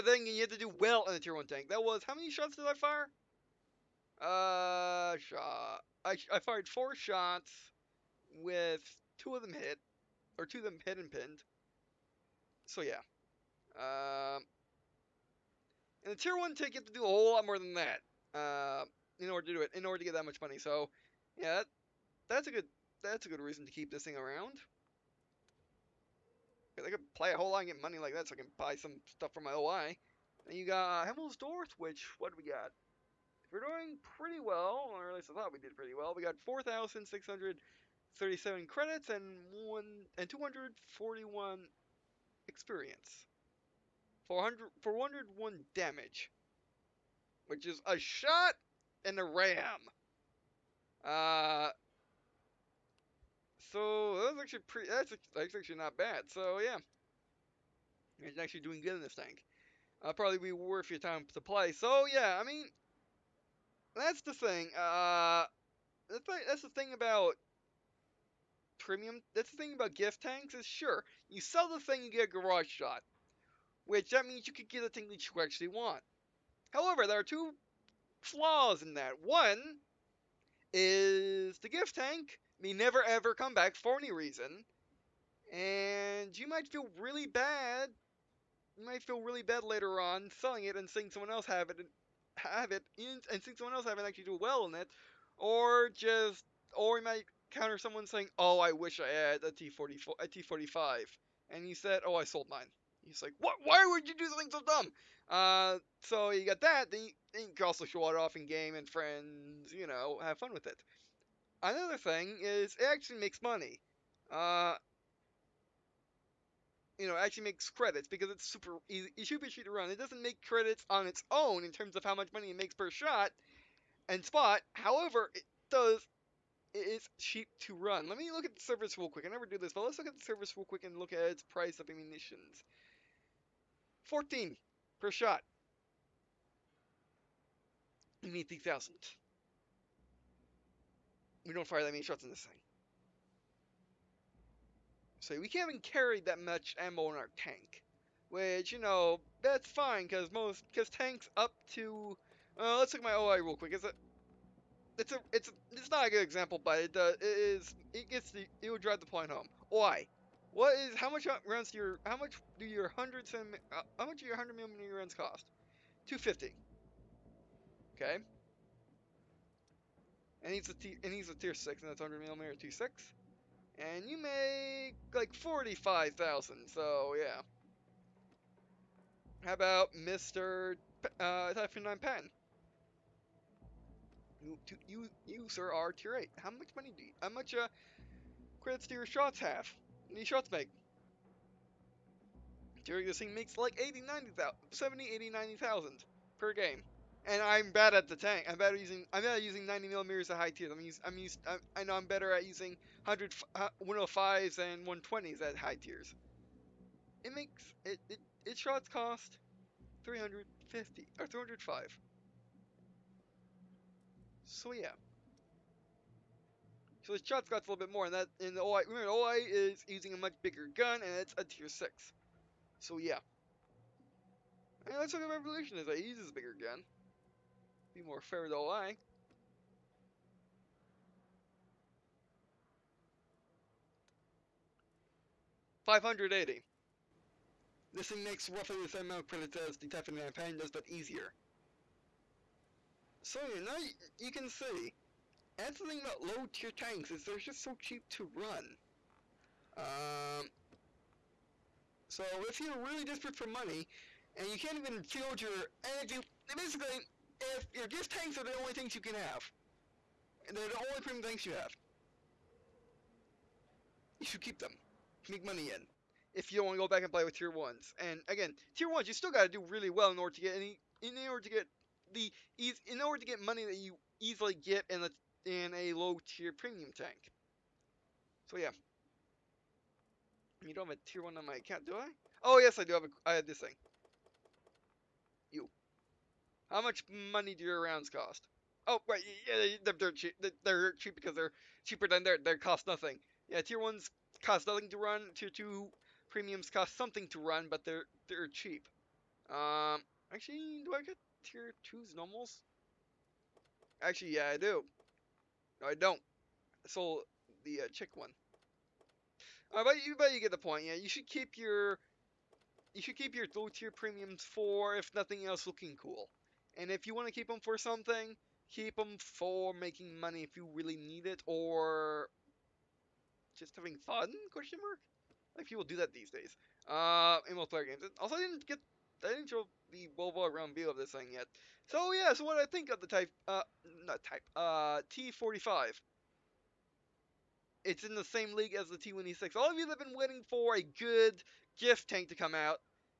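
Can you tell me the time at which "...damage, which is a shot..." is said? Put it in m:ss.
0:45.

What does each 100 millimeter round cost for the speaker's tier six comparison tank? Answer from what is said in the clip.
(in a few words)
250.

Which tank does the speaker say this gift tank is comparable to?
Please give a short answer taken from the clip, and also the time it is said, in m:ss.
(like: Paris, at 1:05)
T1E6, at 5:38.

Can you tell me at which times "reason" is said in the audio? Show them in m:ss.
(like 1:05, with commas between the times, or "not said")
0:23, 1:24.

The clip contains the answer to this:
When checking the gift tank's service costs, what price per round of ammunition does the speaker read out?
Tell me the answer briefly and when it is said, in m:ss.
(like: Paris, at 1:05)
14, at 2:14.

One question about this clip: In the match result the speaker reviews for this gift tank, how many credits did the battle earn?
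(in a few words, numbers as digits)
4,637.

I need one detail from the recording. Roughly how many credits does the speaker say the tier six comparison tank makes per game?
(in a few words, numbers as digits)
45,000.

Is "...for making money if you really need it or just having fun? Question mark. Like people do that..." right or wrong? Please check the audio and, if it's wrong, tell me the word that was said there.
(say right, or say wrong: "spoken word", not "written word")
right.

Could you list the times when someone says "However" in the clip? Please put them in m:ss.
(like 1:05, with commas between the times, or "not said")
1:16, 2:04.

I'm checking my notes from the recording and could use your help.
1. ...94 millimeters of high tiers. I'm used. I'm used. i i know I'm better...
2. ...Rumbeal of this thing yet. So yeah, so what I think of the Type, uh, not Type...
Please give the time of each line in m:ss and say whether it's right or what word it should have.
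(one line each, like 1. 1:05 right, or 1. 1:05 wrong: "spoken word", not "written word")
1. 3:19 wrong: "90", not "94"
2. 5:30 right.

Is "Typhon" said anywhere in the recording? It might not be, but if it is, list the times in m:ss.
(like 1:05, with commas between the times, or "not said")
3:01, 3:59.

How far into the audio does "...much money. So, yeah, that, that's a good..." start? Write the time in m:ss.
0:20.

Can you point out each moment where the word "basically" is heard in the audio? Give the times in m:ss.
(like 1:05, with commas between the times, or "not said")
4:16.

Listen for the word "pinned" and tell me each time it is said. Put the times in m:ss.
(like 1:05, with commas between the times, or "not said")
0:11.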